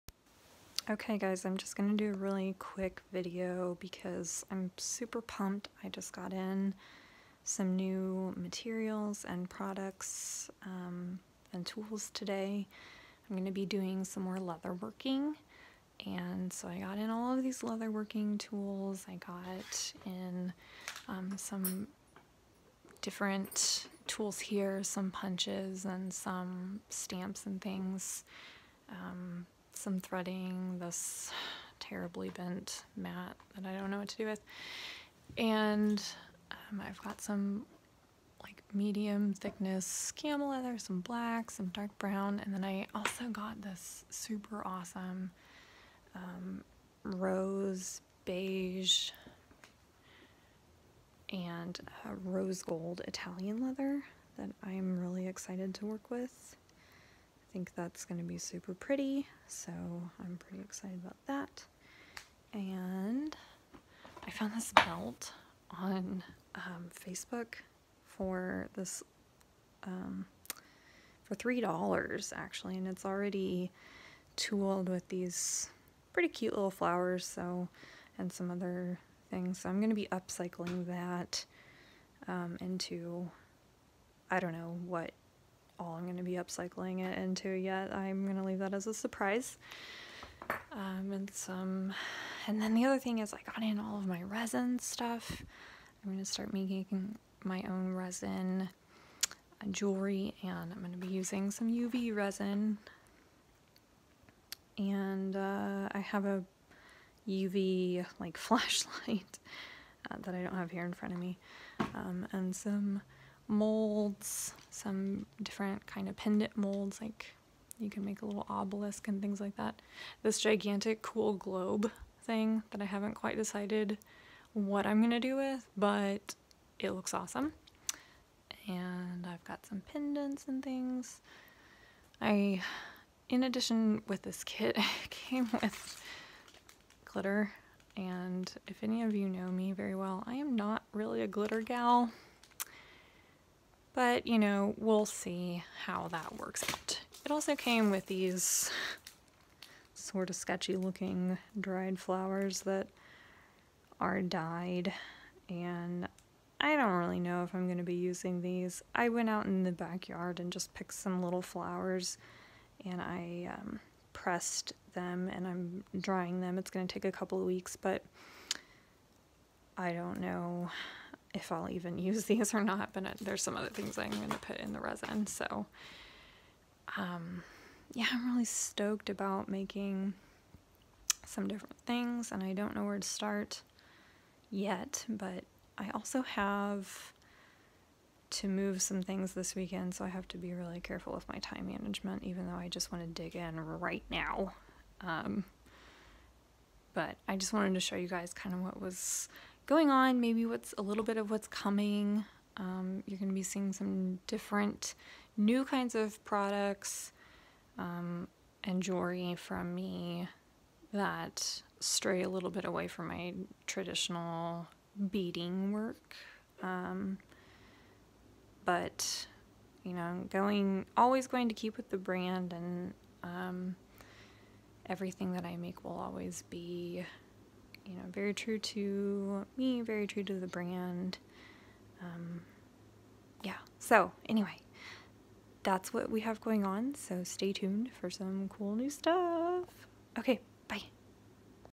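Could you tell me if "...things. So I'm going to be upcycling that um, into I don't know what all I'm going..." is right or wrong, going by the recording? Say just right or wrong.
right.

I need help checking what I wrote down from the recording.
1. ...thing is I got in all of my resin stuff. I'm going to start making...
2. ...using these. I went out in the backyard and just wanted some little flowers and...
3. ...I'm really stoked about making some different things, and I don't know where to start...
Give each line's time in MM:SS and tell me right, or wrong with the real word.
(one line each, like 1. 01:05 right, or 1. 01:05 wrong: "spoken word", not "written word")
1. 01:32 right
2. 02:37 wrong: "picked", not "wanted"
3. 02:58 right.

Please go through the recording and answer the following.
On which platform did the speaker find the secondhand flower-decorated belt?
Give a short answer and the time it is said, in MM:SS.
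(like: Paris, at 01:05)
Facebook, at 01:07.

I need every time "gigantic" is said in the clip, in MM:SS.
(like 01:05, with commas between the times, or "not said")
02:00.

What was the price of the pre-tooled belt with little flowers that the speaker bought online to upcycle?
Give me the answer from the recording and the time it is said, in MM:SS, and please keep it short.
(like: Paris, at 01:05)
$3, at 01:11.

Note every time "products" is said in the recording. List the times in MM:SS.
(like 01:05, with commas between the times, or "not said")
00:09, 03:26.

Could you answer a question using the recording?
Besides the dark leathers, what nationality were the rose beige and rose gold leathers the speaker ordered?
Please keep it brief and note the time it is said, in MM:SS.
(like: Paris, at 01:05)
Italian, at 00:53.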